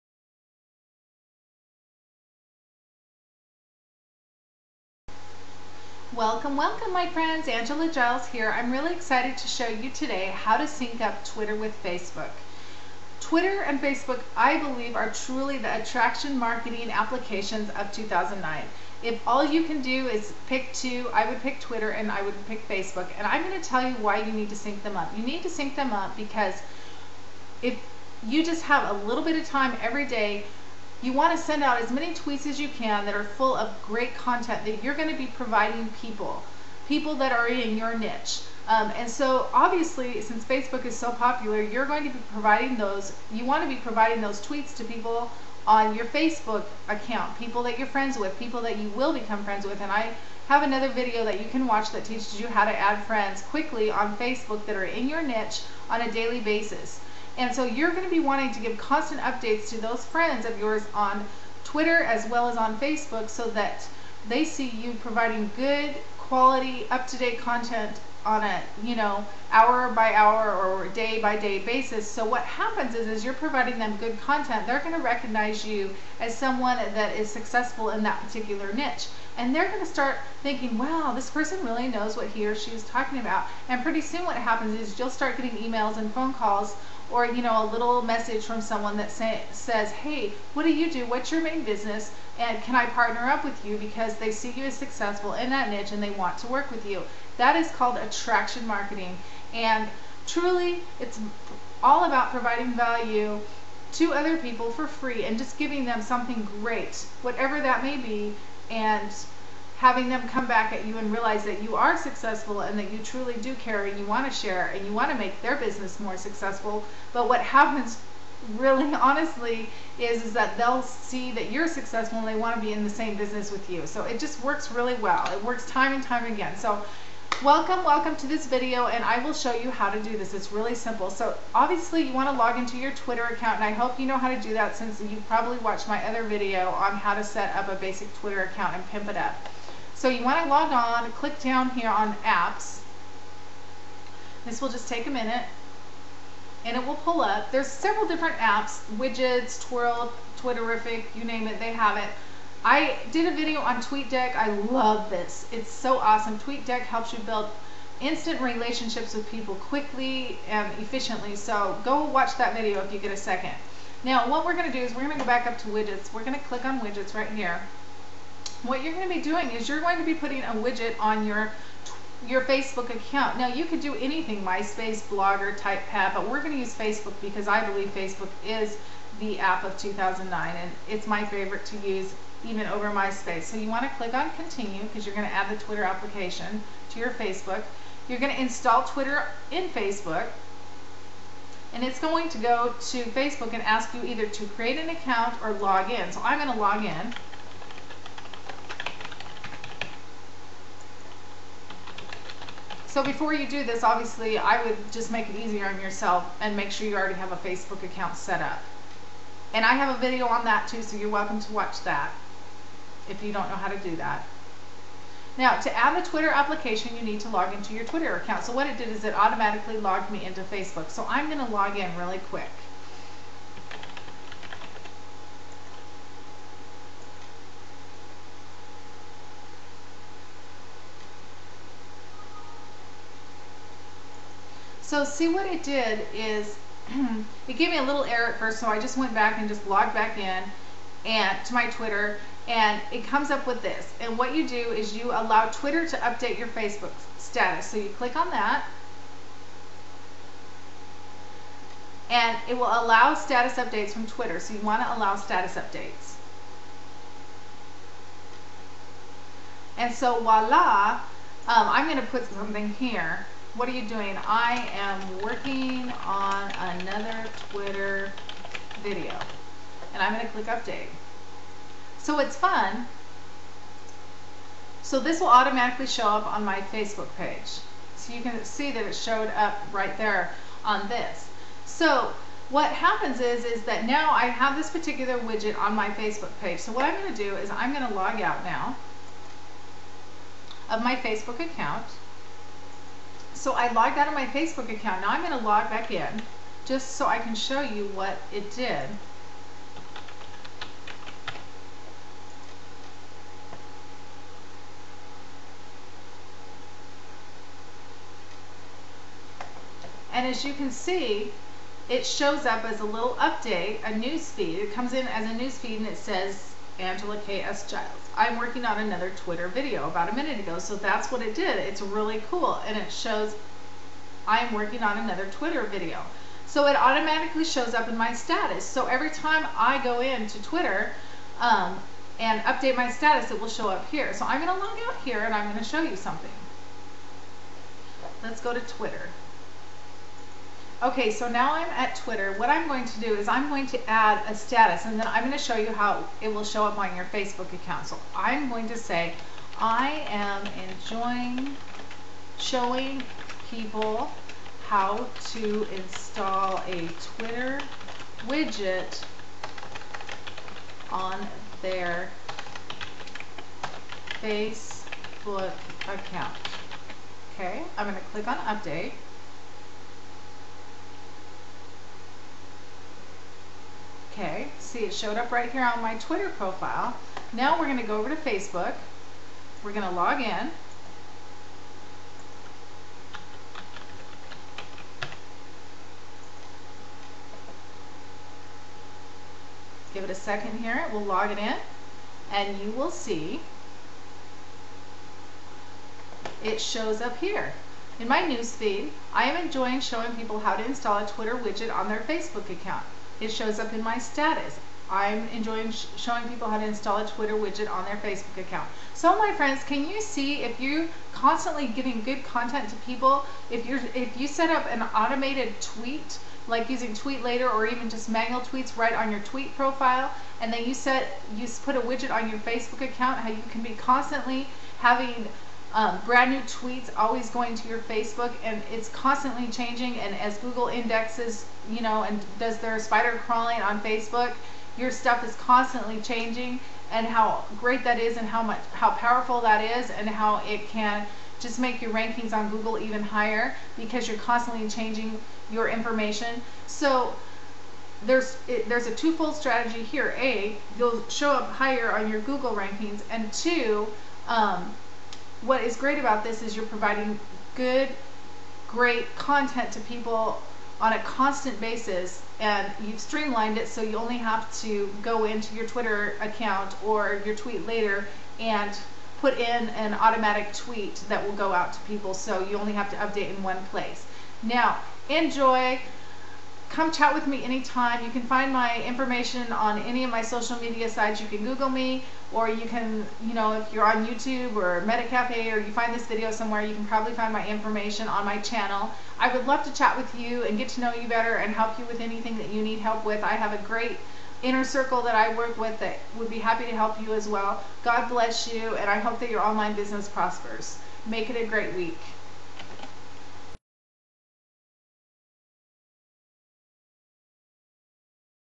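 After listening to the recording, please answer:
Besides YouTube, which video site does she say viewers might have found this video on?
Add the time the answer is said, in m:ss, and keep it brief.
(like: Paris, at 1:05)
MetaCafe, at 8:04.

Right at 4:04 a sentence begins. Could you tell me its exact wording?
And what you do is you allow Twitter to update your Facebook status.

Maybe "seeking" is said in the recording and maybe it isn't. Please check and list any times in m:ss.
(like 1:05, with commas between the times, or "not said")
not said.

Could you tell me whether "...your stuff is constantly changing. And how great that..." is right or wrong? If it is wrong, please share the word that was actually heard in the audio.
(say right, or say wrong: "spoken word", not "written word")
right.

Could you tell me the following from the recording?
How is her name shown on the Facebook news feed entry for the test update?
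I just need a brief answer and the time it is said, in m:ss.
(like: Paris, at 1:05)
Angela K.S. Giles, at 5:16.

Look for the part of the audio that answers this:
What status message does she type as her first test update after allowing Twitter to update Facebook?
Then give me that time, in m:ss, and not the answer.
4:24.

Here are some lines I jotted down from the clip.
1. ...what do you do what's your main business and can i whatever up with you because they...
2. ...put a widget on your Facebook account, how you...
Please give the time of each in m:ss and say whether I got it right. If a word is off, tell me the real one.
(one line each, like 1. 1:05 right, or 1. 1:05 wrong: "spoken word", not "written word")
1. 1:30 wrong: "partner", not "whatever"
2. 7:01 right.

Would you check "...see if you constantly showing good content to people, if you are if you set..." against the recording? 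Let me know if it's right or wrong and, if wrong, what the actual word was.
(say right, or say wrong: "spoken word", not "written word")
wrong: "giving", not "showing".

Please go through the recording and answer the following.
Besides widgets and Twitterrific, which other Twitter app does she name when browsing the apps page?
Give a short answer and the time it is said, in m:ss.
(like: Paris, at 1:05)
Twhirl, at 2:29.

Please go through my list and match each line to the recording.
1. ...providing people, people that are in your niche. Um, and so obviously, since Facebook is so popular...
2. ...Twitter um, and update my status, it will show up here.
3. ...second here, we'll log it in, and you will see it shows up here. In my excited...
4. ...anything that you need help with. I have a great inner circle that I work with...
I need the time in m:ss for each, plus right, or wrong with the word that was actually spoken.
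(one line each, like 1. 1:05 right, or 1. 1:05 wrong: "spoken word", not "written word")
1. 0:35 right
2. 5:30 right
3. 6:30 wrong: "newsfeed", not "excited"
4. 8:11 right.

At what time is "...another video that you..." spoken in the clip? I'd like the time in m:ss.
0:50.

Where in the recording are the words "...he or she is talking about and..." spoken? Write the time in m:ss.
1:22.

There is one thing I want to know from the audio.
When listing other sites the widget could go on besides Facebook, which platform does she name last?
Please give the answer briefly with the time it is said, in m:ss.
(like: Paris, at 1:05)
TypePad, at 2:55.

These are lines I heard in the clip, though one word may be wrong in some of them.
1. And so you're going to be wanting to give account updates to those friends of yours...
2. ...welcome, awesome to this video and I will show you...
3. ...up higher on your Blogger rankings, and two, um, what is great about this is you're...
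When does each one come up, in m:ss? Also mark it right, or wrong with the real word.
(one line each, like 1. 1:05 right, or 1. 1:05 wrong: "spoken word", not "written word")
1. 0:57 wrong: "constant", not "account"
2. 2:07 wrong: "welcome", not "awesome"
3. 7:31 wrong: "Google", not "Blogger".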